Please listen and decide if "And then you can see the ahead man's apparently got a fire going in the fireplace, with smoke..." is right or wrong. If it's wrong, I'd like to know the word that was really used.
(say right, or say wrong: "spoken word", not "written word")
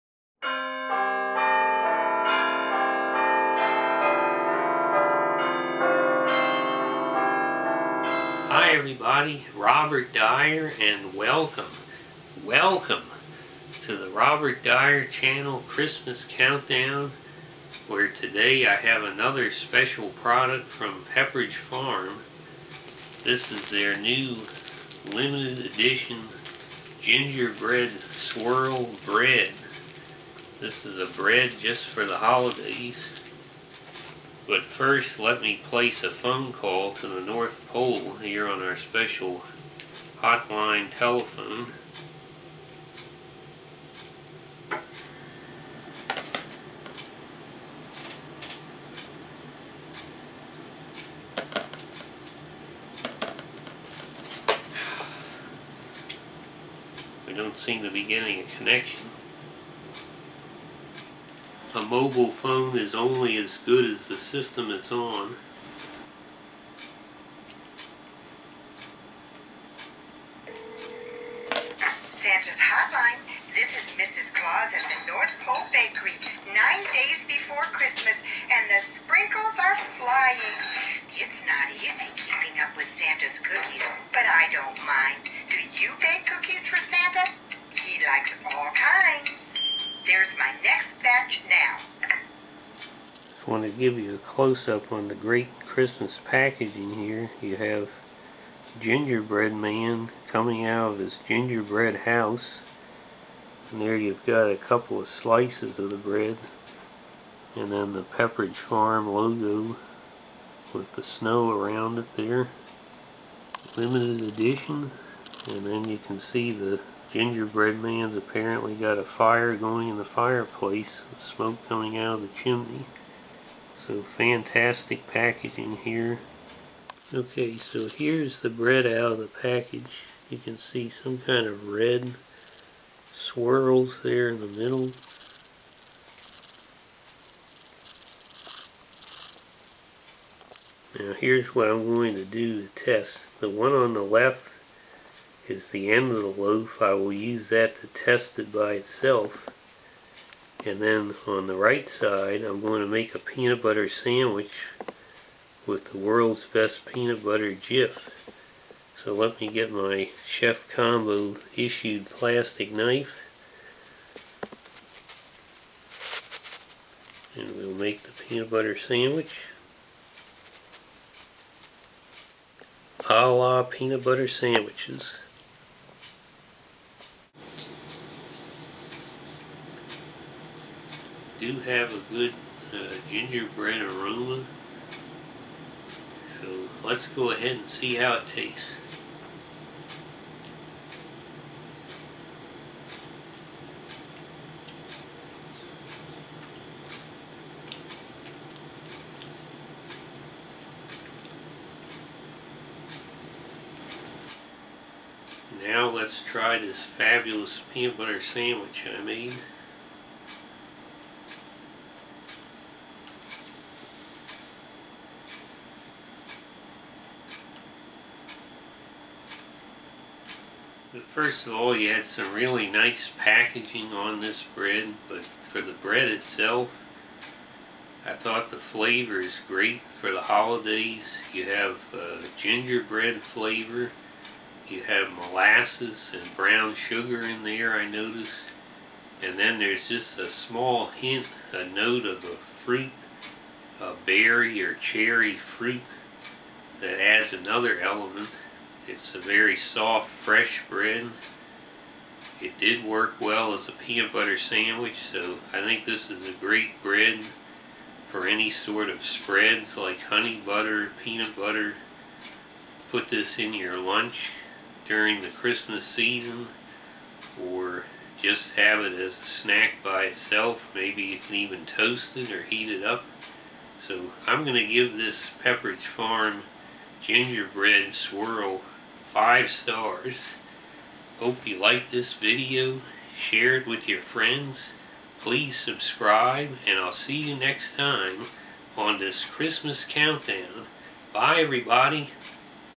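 wrong: "gingerbread", not "ahead".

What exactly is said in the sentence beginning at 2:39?
So let me get my Chef Combo issued plastic knife.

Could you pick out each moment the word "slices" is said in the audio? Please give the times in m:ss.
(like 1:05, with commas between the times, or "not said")
1:45.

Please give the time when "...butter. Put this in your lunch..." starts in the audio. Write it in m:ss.
4:21.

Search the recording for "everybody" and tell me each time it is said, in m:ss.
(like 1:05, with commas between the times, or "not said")
0:08, 4:51.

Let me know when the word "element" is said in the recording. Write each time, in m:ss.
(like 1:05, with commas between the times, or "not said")
4:07.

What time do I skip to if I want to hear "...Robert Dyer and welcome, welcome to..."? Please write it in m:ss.
0:09.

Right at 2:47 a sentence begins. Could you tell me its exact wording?
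And we'll make the peanut butter sandwich.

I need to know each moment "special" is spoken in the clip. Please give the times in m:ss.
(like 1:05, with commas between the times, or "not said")
0:19, 0:38.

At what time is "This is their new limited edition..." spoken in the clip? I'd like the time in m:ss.
0:23.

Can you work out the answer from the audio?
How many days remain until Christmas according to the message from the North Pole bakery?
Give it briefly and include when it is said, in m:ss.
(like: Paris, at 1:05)
9, at 1:16.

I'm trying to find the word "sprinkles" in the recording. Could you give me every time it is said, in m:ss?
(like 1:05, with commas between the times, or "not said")
1:18.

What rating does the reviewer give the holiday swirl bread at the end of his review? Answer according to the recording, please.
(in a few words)
5 stars.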